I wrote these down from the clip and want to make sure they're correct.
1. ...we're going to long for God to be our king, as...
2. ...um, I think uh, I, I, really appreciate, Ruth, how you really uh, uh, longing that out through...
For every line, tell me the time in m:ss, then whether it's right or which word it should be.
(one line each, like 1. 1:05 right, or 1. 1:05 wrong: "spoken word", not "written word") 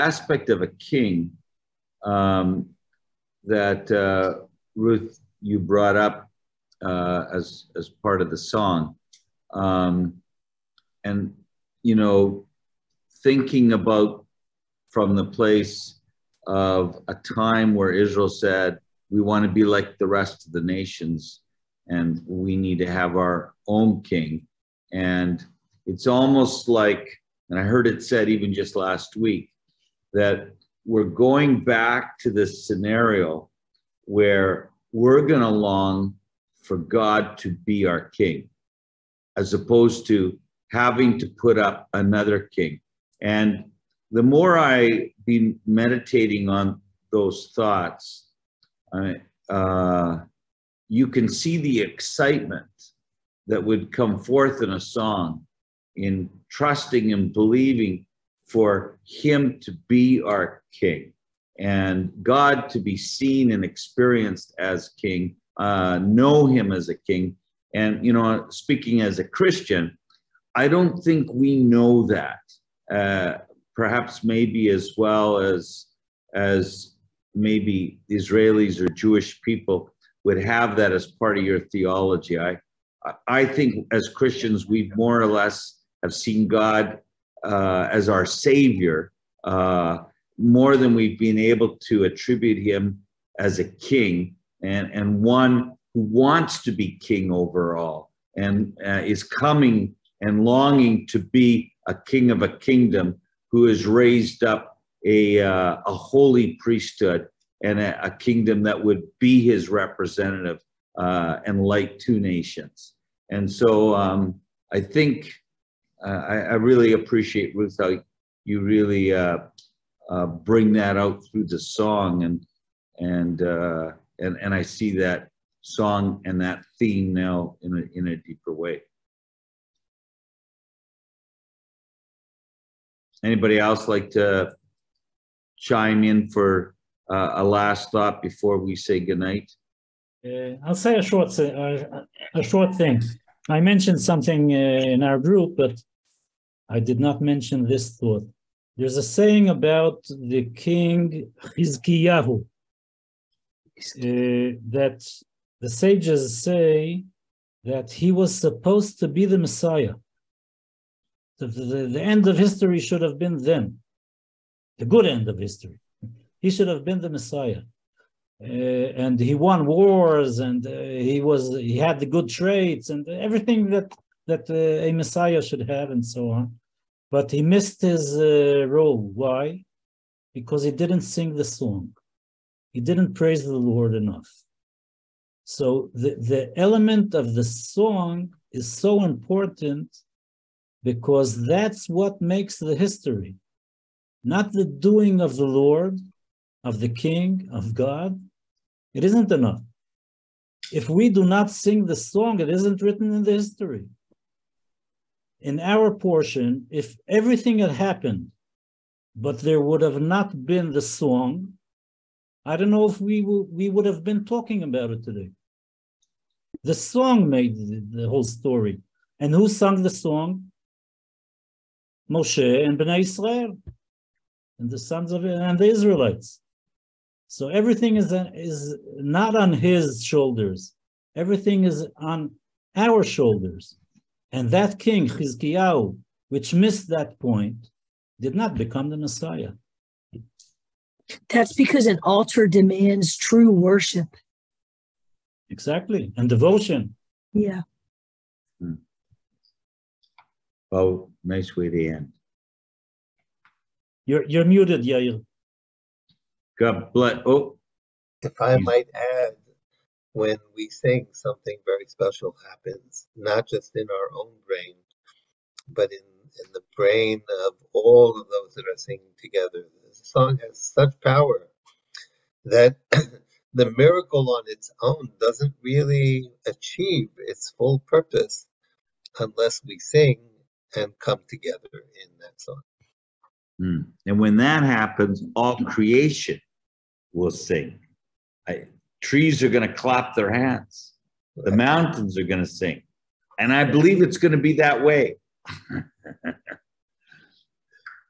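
1. 0:34 right
2. 1:53 wrong: "bring", not "longing".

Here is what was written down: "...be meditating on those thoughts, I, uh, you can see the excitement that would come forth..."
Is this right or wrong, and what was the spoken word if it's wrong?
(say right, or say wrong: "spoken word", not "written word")
right.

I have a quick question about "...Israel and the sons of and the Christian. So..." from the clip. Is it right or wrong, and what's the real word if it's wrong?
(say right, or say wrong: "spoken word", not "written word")
wrong: "Israelites", not "Christian".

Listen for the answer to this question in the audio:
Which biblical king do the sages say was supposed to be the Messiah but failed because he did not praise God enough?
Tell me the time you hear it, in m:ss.
2:31.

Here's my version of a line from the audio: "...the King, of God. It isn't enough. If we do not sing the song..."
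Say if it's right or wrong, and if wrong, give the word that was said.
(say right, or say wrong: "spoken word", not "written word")
right.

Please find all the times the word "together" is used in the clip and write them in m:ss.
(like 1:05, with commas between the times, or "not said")
4:29, 4:41.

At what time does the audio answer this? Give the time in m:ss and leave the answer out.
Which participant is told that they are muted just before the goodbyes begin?
4:14.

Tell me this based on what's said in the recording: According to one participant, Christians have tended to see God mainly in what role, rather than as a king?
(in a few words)
Savior.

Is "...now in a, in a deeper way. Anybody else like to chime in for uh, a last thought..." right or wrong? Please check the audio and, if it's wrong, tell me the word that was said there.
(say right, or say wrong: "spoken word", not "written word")
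right.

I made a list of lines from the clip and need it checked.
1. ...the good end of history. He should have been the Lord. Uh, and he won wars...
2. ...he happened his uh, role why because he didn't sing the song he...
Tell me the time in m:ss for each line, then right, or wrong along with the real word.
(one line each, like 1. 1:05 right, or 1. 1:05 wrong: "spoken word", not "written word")
1. 2:44 wrong: "Messiah", not "Lord"
2. 2:57 wrong: "missed", not "happened".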